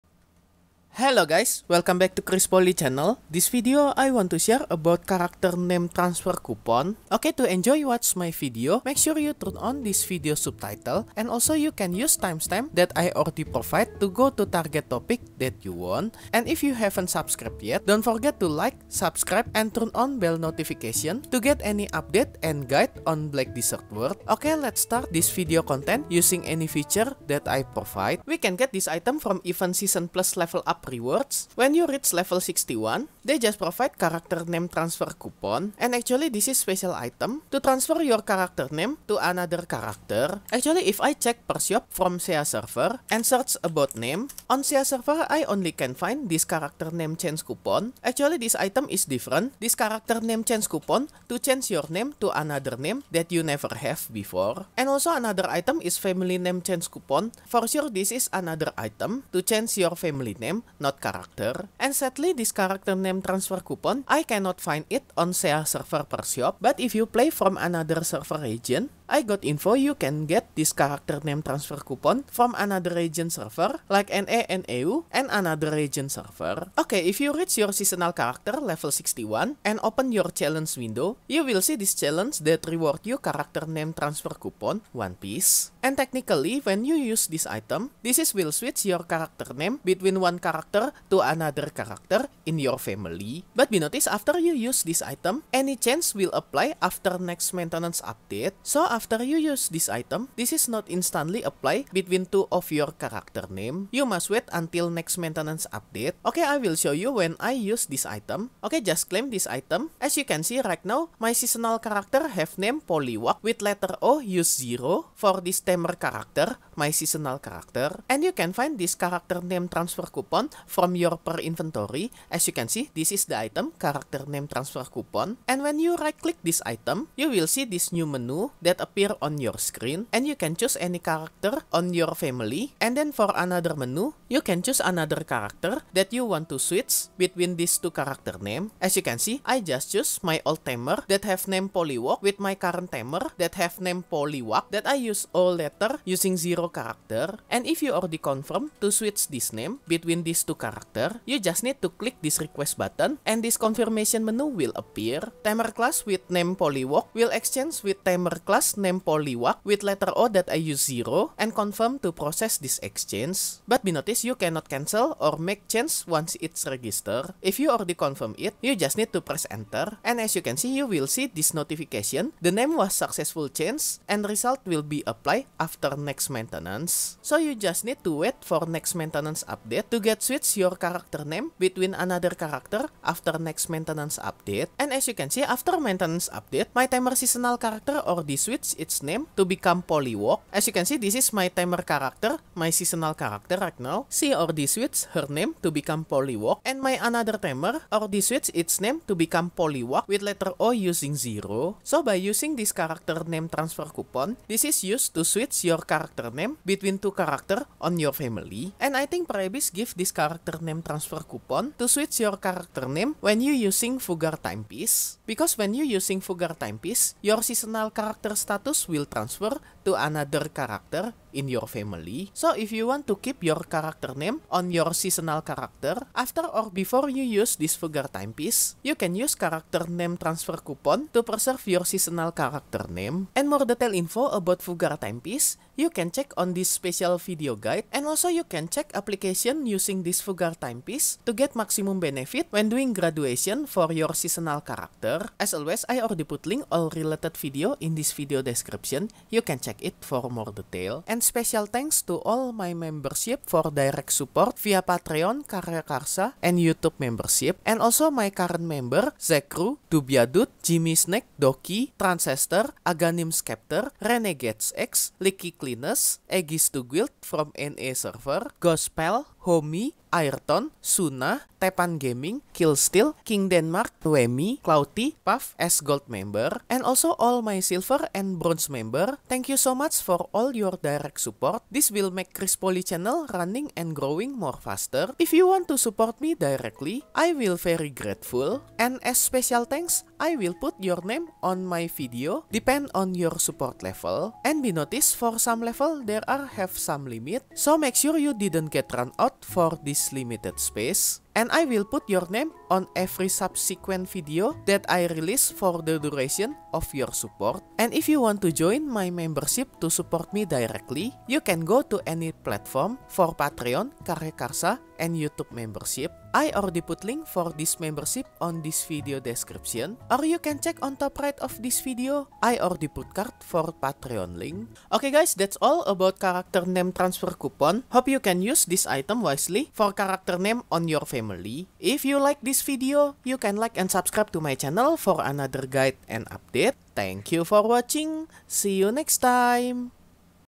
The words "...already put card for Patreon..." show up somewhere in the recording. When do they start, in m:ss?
5:22.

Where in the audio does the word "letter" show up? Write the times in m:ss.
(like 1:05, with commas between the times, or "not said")
1:53, 2:25, 2:39, 3:20.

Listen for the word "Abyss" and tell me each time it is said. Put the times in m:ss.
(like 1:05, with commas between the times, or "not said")
3:29.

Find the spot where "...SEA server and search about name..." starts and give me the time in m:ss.
0:42.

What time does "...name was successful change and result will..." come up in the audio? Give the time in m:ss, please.
2:52.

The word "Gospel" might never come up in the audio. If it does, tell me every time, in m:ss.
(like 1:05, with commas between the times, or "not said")
4:28.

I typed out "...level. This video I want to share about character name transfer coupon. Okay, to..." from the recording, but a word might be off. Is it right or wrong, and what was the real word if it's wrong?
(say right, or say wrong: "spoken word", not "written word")
wrong: "channel", not "level".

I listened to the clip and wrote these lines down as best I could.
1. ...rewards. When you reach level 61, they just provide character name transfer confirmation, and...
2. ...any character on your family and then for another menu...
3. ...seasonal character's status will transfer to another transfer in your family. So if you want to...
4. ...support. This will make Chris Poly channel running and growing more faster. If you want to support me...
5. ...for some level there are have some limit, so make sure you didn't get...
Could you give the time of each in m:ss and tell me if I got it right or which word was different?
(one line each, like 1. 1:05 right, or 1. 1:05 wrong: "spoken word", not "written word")
1. 0:30 wrong: "coupon", not "confirmation"
2. 2:10 right
3. 3:37 wrong: "character", not "transfer"
4. 4:41 right
5. 4:55 right.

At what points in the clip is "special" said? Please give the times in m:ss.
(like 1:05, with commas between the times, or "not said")
0:36, 3:56, 4:11, 4:49.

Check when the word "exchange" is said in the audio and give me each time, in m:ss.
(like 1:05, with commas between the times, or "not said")
2:37, 2:42.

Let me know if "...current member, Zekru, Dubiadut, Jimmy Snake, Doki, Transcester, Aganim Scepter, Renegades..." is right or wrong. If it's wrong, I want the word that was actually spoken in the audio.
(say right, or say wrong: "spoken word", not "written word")
right.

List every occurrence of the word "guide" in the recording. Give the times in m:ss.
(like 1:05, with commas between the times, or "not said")
0:22, 3:57, 5:35.